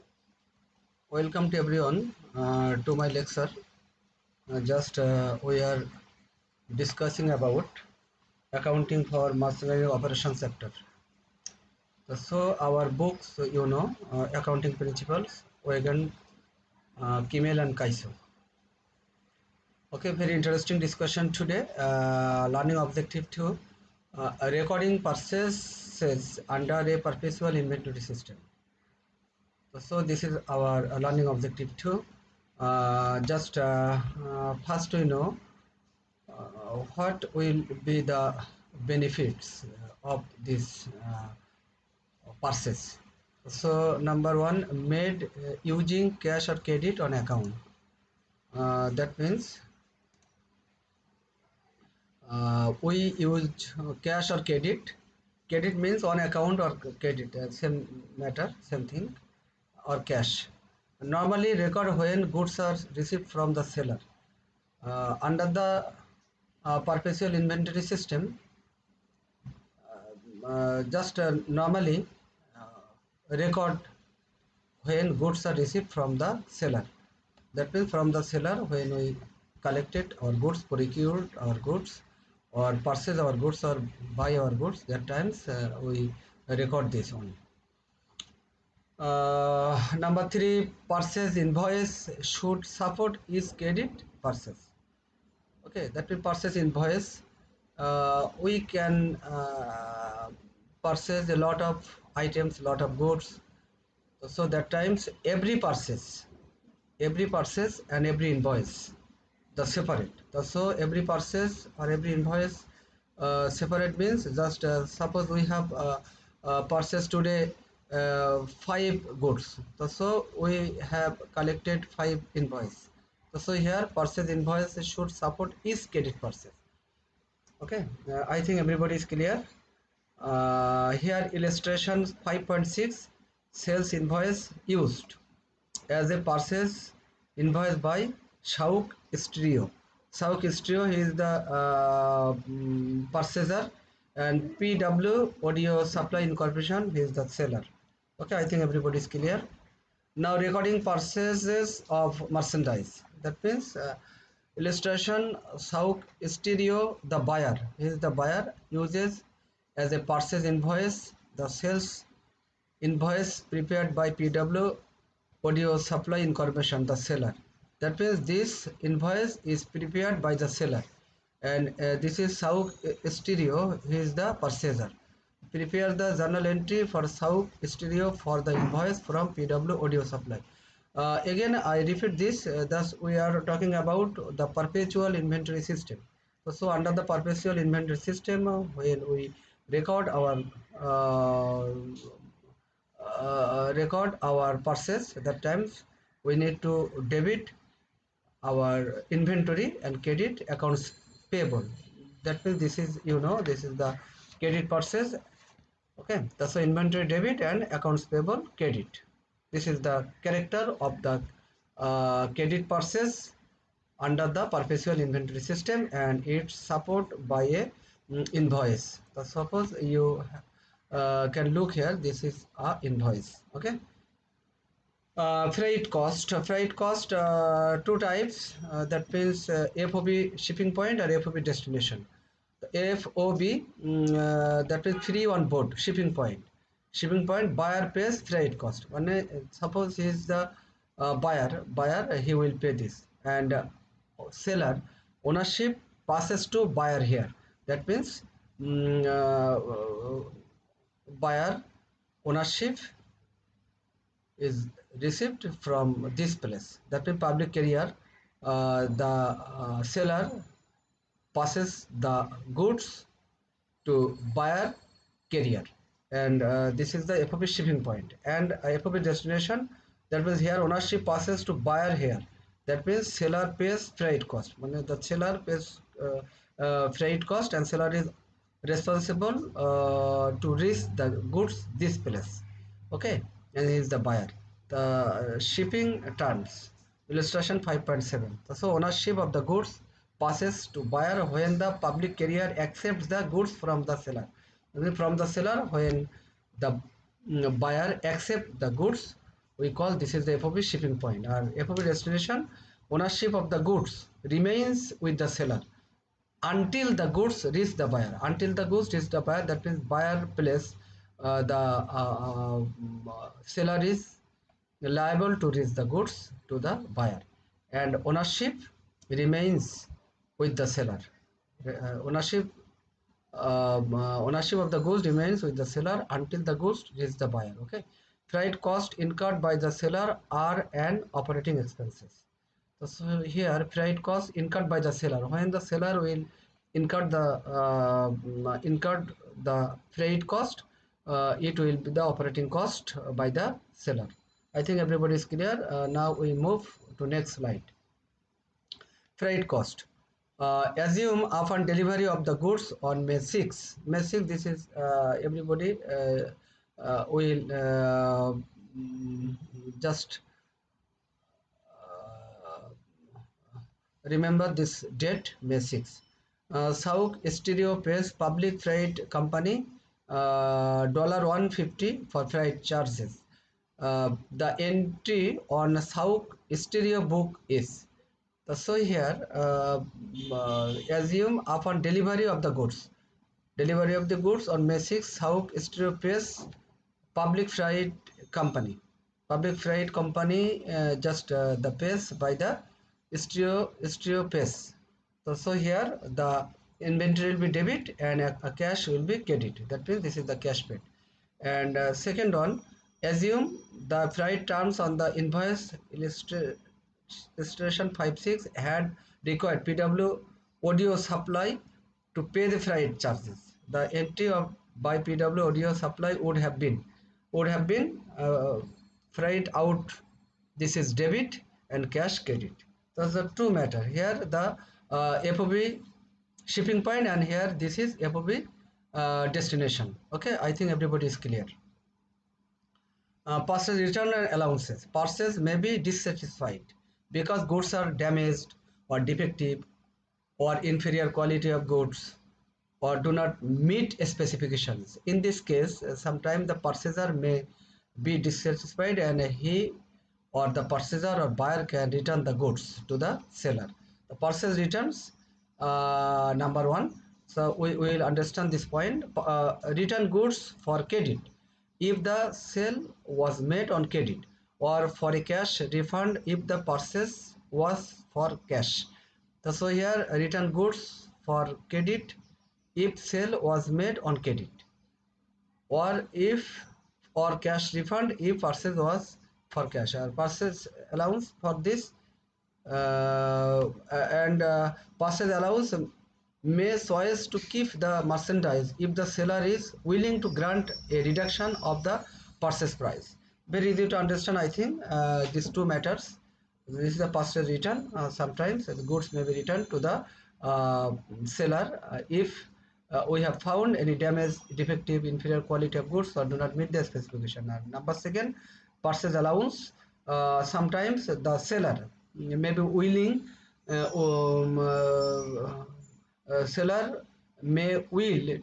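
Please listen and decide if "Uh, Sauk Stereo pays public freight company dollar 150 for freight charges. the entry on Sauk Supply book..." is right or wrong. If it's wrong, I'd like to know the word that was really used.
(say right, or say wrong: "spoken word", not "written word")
wrong: "Stereo", not "Supply".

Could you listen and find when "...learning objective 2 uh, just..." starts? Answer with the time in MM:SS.
00:31.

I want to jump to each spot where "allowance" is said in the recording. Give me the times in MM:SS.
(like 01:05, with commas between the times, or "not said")
07:14, 08:00, 08:05, 08:29.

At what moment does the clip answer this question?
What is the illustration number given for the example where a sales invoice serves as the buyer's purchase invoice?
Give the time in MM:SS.
02:11.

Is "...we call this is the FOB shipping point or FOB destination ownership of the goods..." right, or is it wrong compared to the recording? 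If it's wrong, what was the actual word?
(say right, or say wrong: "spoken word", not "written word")
right.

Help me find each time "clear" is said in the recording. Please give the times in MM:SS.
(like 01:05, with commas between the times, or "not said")
02:09, 02:29, 05:45, 07:11.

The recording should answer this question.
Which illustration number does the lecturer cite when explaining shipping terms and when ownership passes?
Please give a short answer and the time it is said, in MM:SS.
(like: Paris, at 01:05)
5.7, at 04:47.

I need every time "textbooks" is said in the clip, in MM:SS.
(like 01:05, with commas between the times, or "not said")
not said.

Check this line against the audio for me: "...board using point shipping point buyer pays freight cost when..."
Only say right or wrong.
wrong.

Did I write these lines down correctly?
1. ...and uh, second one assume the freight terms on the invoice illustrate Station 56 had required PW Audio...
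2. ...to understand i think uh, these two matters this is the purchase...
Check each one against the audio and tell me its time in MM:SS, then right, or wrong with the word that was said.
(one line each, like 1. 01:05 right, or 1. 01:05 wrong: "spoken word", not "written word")
1. 06:41 right
2. 08:13 right.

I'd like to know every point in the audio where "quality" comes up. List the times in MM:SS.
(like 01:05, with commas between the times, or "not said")
07:21, 08:25.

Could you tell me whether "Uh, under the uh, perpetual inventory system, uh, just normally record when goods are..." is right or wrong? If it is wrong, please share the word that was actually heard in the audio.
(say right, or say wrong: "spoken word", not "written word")
right.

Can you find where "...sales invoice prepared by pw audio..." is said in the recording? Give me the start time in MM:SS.
02:41.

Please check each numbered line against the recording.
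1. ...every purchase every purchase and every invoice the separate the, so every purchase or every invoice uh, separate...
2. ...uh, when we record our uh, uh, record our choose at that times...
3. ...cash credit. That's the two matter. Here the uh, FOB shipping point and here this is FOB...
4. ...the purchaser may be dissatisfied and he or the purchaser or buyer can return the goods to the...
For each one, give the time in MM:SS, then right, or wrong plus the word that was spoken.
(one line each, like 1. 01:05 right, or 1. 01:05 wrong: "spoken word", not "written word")
1. 01:45 right
2. 03:08 wrong: "purchase", not "choose"
3. 07:01 right
4. 07:26 right.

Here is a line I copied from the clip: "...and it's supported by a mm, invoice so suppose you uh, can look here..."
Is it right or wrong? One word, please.
right.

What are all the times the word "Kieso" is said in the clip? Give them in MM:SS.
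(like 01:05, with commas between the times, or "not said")
00:17.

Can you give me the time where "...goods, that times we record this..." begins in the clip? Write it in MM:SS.
01:24.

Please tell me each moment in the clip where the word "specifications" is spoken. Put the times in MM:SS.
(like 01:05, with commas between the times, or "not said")
07:24, 08:26.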